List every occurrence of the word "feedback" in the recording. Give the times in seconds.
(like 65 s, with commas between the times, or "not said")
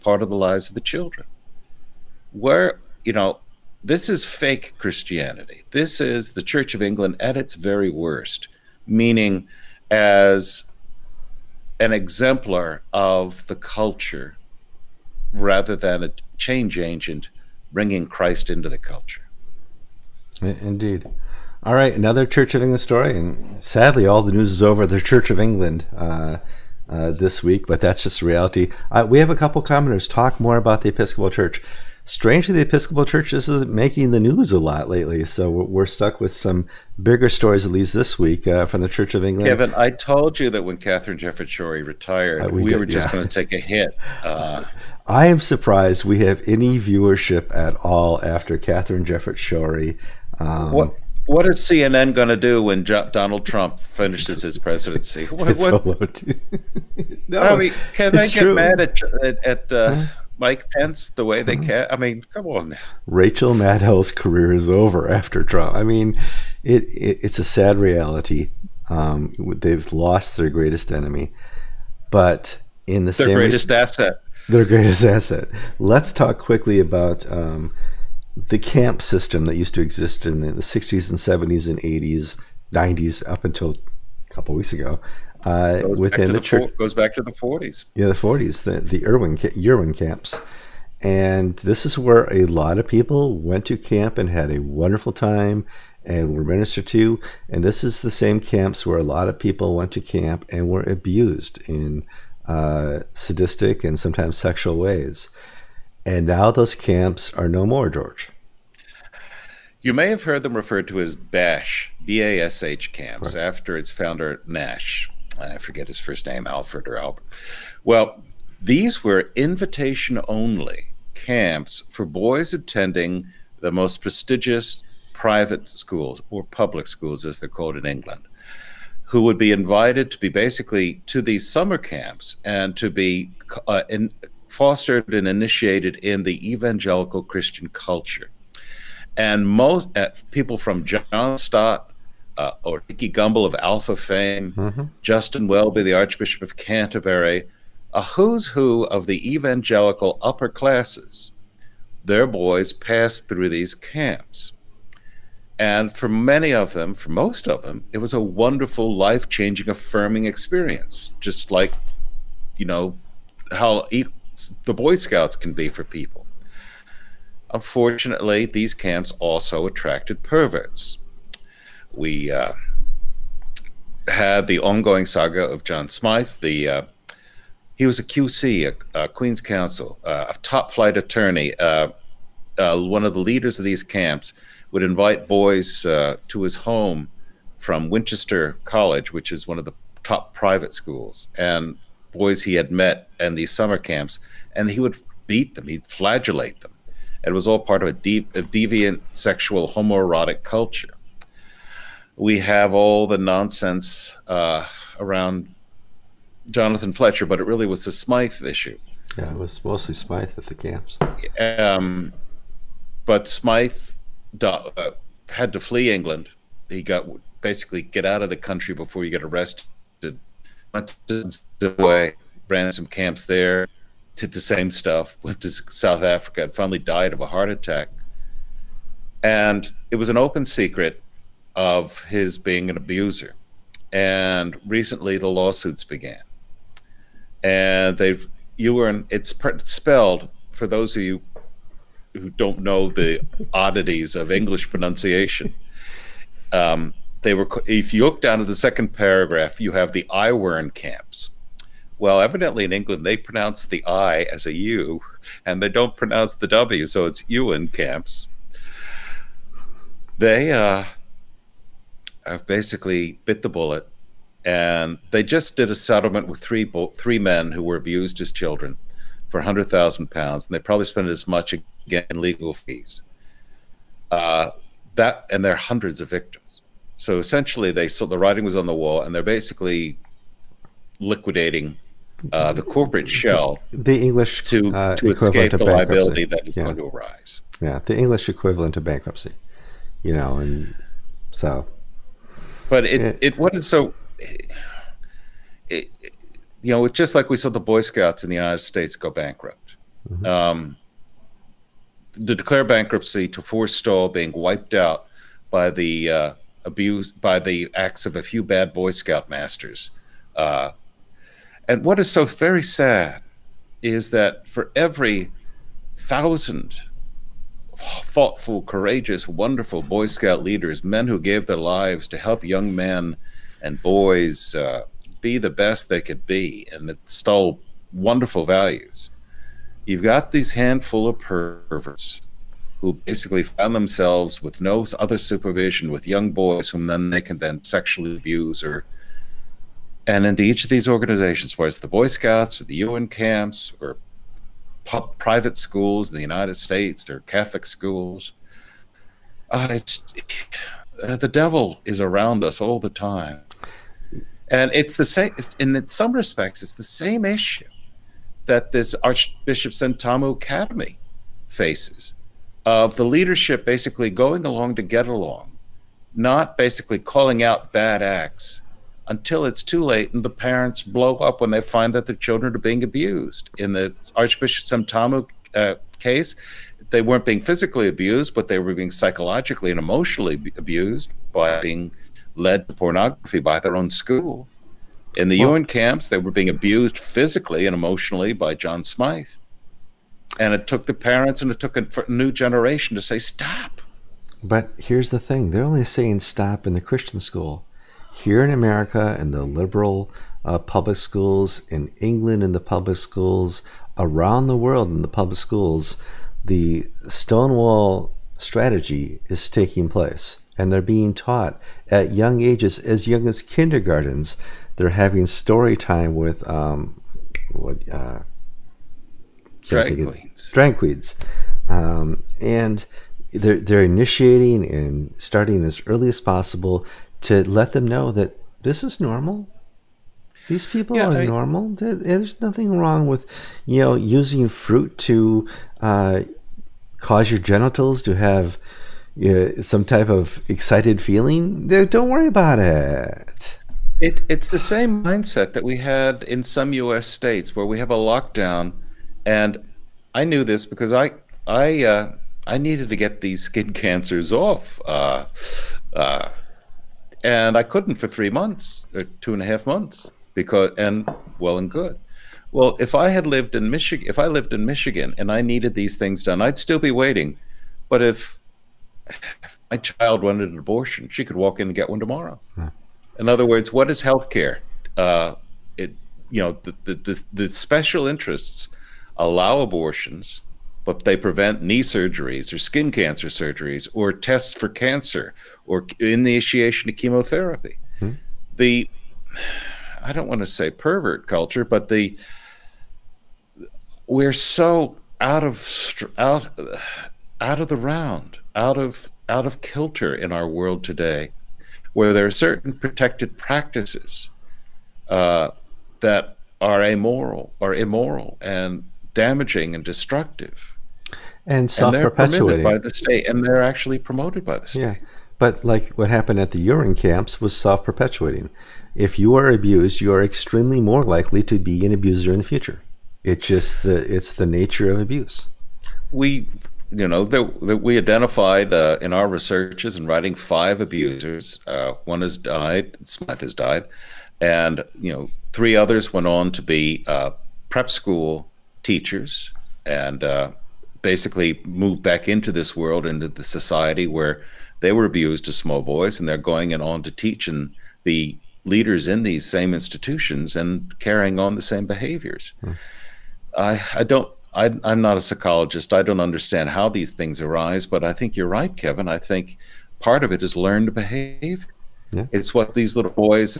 not said.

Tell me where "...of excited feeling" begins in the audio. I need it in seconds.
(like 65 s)
440 s.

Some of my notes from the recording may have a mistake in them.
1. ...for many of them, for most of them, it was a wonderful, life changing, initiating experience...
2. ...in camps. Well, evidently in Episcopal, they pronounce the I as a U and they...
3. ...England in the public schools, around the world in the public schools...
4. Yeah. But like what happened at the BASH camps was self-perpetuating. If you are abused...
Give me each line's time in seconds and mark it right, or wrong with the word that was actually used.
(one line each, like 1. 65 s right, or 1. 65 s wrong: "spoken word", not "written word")
1. 155 s wrong: "affirming", not "initiating"
2. 250 s wrong: "England", not "Episcopal"
3. 401 s right
4. 514 s wrong: "Iwerne", not "BASH".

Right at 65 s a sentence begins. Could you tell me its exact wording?
I mean, it, it it's a sad reality.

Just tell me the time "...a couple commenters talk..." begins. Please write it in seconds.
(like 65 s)
29 s.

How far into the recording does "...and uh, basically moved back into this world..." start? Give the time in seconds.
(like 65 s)
539 s.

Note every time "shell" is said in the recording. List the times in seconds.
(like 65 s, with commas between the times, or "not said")
283 s.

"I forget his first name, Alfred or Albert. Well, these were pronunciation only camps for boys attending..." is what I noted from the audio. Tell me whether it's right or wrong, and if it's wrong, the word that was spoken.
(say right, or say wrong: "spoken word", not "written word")
wrong: "invitation", not "pronunciation".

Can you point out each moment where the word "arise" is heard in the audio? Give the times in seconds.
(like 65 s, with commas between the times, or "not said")
286 s, 557 s.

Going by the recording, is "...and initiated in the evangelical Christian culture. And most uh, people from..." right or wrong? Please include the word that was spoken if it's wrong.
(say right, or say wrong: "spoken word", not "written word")
right.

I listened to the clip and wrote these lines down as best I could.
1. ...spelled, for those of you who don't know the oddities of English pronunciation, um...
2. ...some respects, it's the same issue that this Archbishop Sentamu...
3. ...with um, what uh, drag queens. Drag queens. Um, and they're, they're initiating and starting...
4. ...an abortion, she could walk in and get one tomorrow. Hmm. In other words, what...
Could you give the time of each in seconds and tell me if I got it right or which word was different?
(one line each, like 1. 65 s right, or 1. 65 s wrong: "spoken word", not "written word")
1. 239 s right
2. 355 s right
3. 416 s right
4. 470 s right.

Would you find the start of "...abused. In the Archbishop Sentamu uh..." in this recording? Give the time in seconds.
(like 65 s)
372 s.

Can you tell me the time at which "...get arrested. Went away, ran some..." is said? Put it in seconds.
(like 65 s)
219 s.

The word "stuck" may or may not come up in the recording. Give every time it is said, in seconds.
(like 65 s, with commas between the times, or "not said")
35 s.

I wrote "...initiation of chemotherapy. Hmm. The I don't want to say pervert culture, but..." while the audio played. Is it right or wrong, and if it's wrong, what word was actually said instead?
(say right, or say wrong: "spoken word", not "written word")
right.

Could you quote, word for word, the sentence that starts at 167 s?
Unfortunately, these camps also attracted perverts we uh, had the ongoing saga of John Smythe.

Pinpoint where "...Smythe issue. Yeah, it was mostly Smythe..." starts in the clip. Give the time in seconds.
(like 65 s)
207 s.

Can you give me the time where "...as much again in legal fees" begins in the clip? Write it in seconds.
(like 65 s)
271 s.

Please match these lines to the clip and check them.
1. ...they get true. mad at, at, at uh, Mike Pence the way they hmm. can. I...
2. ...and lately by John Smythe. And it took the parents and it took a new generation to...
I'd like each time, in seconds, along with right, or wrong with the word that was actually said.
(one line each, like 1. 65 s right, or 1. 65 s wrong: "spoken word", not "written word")
1. 58 s right
2. 387 s wrong: "emotionally", not "lately".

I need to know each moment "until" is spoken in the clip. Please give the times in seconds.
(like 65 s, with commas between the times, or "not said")
83 s, 369 s.